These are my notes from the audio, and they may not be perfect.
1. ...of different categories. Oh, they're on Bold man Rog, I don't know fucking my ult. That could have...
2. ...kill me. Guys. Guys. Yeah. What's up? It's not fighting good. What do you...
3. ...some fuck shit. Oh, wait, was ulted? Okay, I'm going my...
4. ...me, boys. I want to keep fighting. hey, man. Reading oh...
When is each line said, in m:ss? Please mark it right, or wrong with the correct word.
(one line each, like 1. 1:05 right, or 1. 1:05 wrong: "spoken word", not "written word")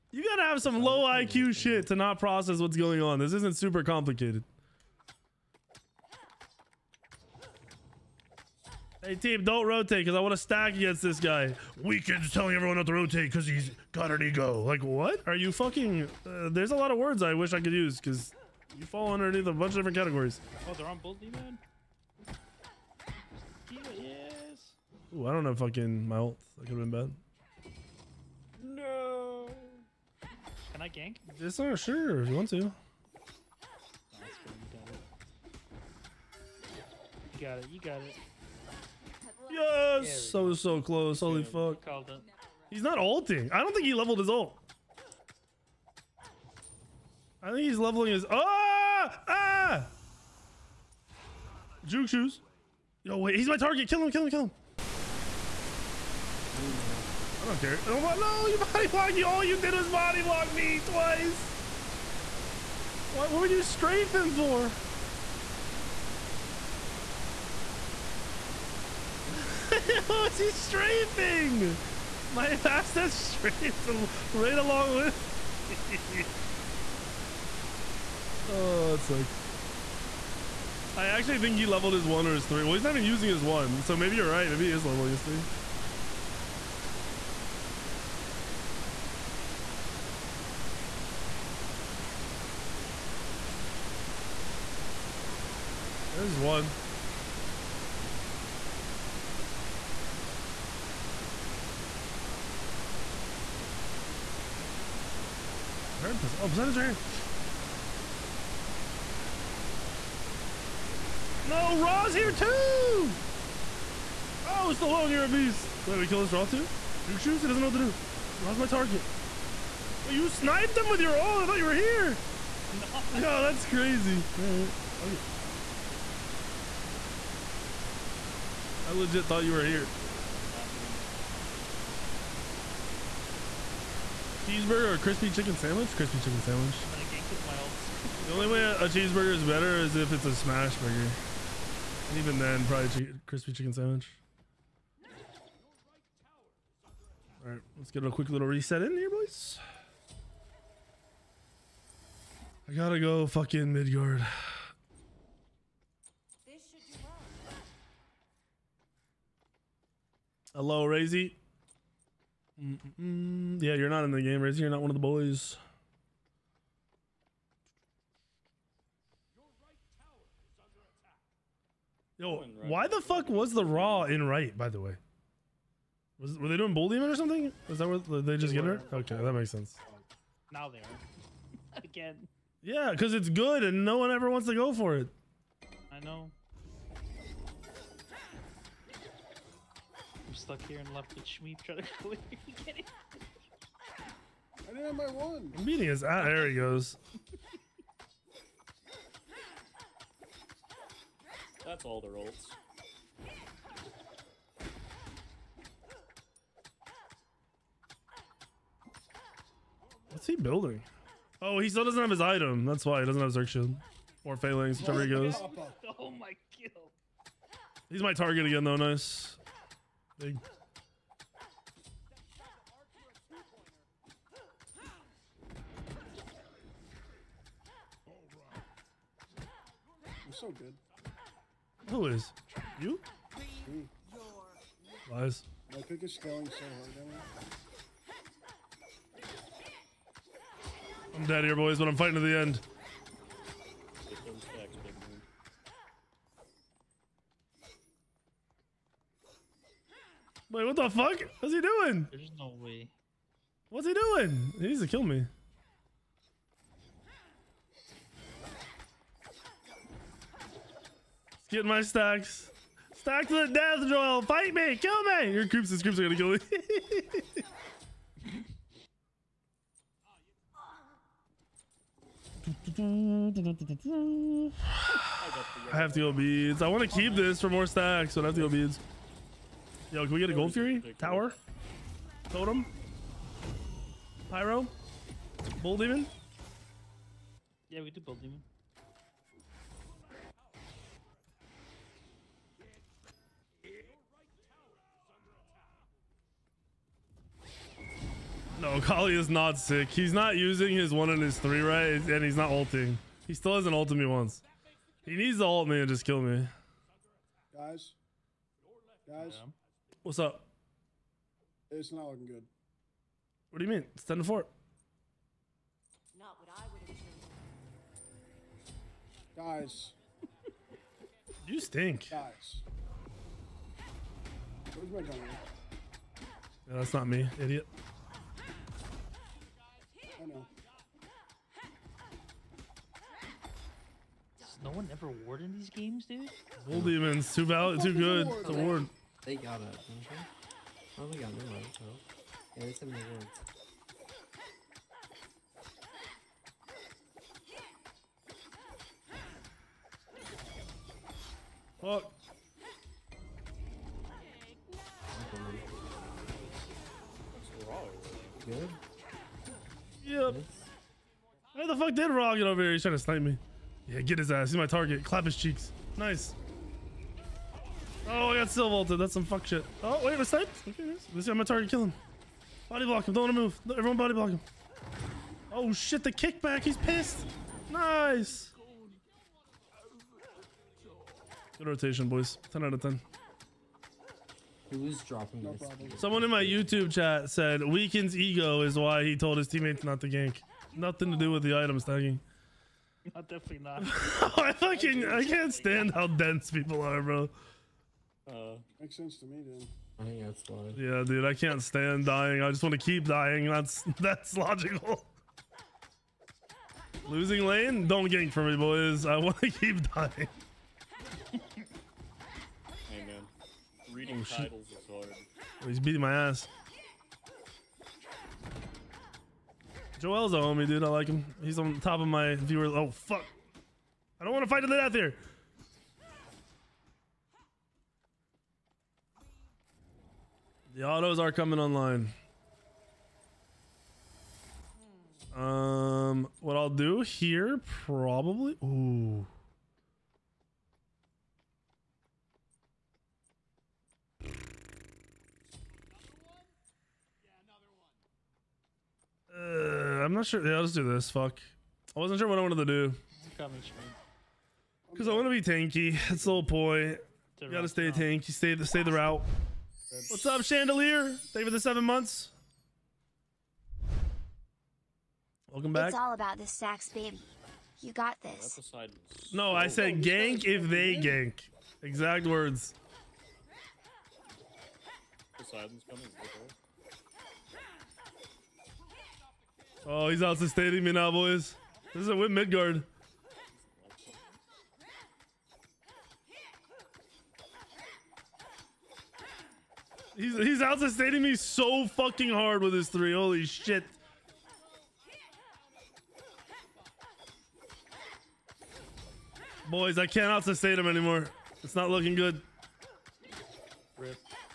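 1. 0:19 wrong: "Ooh", not "Rog"
2. 5:06 wrong: "looking", not "fighting"
3. 6:09 wrong: "sniped", not "ulted"
4. 6:48 wrong: "dying", not "fighting".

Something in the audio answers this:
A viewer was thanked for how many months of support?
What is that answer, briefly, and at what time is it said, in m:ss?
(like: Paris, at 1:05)
7 months, at 7:41.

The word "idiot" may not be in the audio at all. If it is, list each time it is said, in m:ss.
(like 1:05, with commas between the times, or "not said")
5:27.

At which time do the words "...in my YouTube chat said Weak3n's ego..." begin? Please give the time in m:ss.
6:26.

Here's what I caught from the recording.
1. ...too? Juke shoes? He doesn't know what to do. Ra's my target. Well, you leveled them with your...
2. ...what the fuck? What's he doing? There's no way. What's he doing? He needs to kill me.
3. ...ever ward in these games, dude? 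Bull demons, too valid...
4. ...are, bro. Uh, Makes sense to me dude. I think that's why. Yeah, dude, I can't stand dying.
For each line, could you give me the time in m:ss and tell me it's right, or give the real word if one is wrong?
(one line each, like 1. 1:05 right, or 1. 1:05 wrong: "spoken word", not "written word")
1. 1:56 wrong: "sniped", not "leveled"
2. 4:10 right
3. 5:34 right
4. 6:36 right.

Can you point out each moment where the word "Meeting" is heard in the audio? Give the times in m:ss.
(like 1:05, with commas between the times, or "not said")
3:15.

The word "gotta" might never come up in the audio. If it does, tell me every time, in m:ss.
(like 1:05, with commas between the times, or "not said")
0:00, 2:32, 7:37.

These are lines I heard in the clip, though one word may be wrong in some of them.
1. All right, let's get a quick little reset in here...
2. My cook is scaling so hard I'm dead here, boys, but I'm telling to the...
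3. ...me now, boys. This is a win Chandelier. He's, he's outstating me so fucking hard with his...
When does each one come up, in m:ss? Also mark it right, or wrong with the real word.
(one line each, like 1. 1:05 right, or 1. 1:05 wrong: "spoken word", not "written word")
1. 2:27 right
2. 3:55 wrong: "fighting", not "telling"
3. 8:00 wrong: "Midgard", not "Chandelier".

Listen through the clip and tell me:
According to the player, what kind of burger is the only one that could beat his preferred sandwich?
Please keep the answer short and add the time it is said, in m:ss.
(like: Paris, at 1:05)
Smash burger, at 2:20.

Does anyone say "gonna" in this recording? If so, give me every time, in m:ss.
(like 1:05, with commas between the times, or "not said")
2:16, 4:26.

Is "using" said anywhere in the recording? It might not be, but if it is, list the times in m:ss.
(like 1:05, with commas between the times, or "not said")
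1:23, 5:00.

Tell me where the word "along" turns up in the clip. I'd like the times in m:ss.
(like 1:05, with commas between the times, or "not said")
1:14.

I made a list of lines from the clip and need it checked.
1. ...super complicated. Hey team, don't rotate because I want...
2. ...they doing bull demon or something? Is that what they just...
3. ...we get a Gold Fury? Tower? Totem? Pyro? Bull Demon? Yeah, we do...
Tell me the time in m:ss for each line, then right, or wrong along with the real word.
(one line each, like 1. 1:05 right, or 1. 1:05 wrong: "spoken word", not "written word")
1. 0:03 right
2. 2:56 right
3. 4:40 right.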